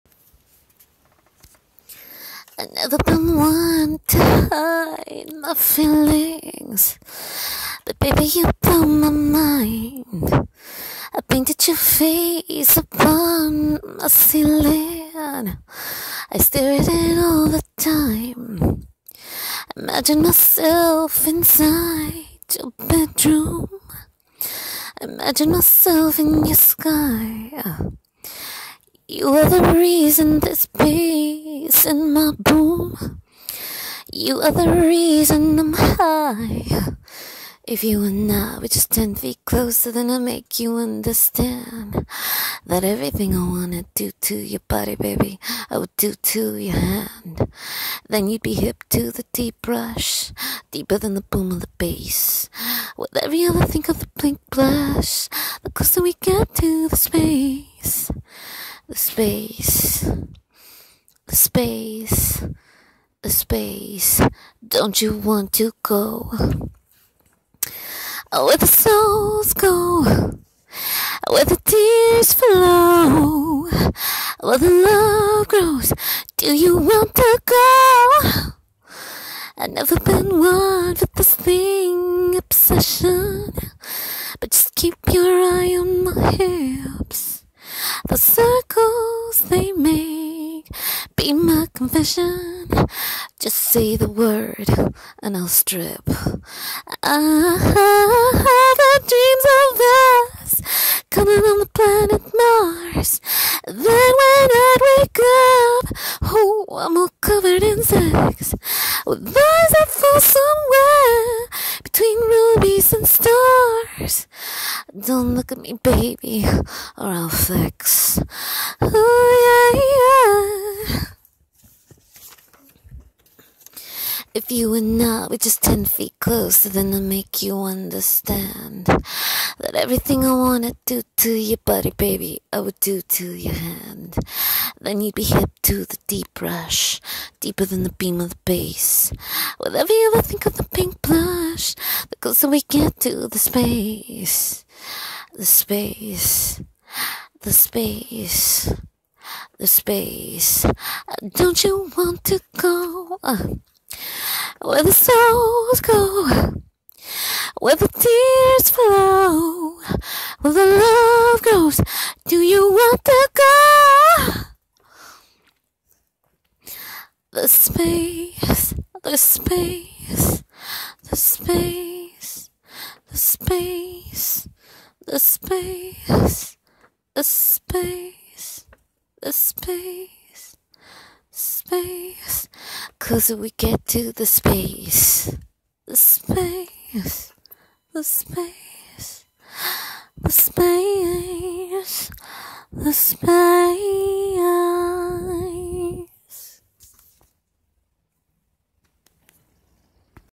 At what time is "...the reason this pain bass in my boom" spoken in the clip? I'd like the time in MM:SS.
00:29.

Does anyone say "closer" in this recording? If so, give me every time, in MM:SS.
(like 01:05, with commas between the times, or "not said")
00:39, 00:55, 02:06, 02:22.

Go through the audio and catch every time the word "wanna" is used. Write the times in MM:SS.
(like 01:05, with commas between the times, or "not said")
00:43, 02:10.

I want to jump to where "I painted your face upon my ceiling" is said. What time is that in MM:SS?
00:11.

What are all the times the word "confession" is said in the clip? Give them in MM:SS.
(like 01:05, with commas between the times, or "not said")
01:31.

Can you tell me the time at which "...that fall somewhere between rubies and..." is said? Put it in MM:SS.
01:49.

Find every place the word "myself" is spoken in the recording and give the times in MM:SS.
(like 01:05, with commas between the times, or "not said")
00:20, 00:25.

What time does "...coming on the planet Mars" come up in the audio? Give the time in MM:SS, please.
01:41.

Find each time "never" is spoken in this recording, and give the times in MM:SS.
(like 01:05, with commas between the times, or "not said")
00:02, 01:19.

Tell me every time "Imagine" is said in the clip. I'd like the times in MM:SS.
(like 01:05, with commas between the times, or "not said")
00:19, 00:25.